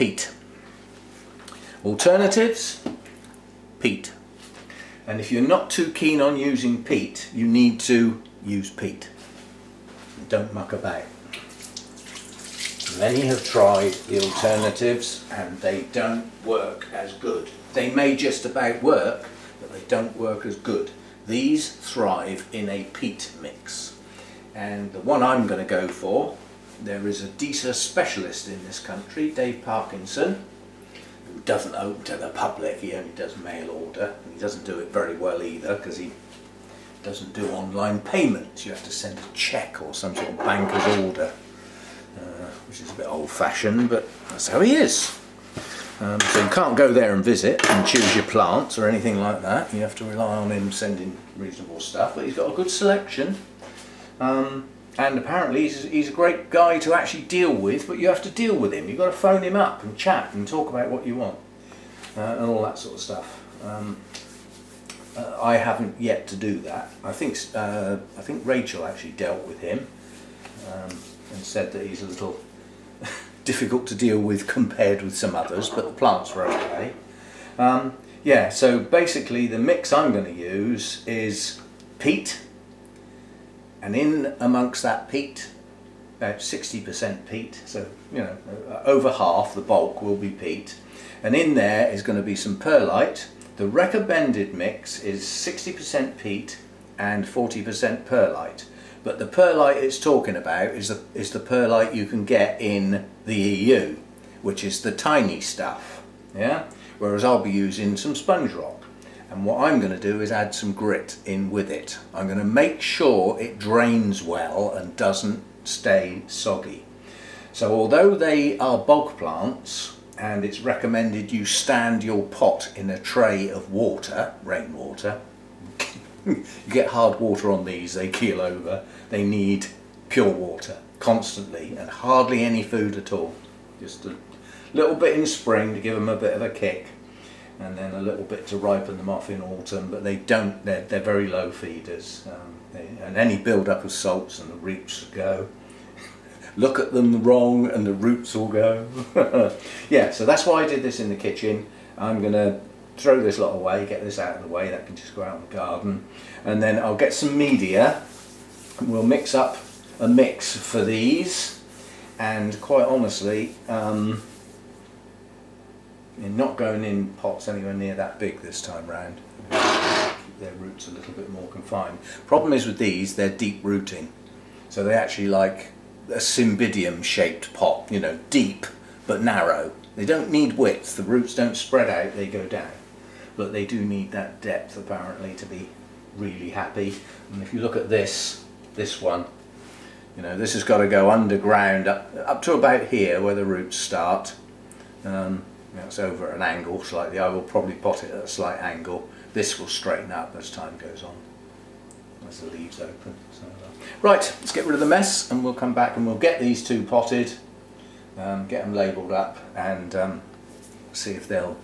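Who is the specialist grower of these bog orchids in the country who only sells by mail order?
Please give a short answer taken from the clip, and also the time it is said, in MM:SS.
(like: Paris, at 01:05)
Dave Parkinson, at 00:29.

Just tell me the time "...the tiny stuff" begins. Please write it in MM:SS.
01:44.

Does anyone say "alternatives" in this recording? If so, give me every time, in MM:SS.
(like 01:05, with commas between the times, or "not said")
00:01, 00:14.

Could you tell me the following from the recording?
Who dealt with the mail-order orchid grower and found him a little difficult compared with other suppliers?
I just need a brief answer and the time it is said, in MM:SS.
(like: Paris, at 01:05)
Rachel, at 01:08.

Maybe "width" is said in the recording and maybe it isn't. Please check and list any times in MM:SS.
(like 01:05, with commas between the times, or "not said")
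03:00.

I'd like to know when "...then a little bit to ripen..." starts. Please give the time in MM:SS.
02:17.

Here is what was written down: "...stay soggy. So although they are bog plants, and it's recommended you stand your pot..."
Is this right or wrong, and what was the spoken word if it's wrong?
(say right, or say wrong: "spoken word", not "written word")
right.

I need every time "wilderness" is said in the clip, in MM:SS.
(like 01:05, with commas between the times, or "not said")
not said.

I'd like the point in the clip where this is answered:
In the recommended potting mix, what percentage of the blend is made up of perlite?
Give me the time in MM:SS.
01:37.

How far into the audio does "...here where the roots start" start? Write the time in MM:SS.
03:12.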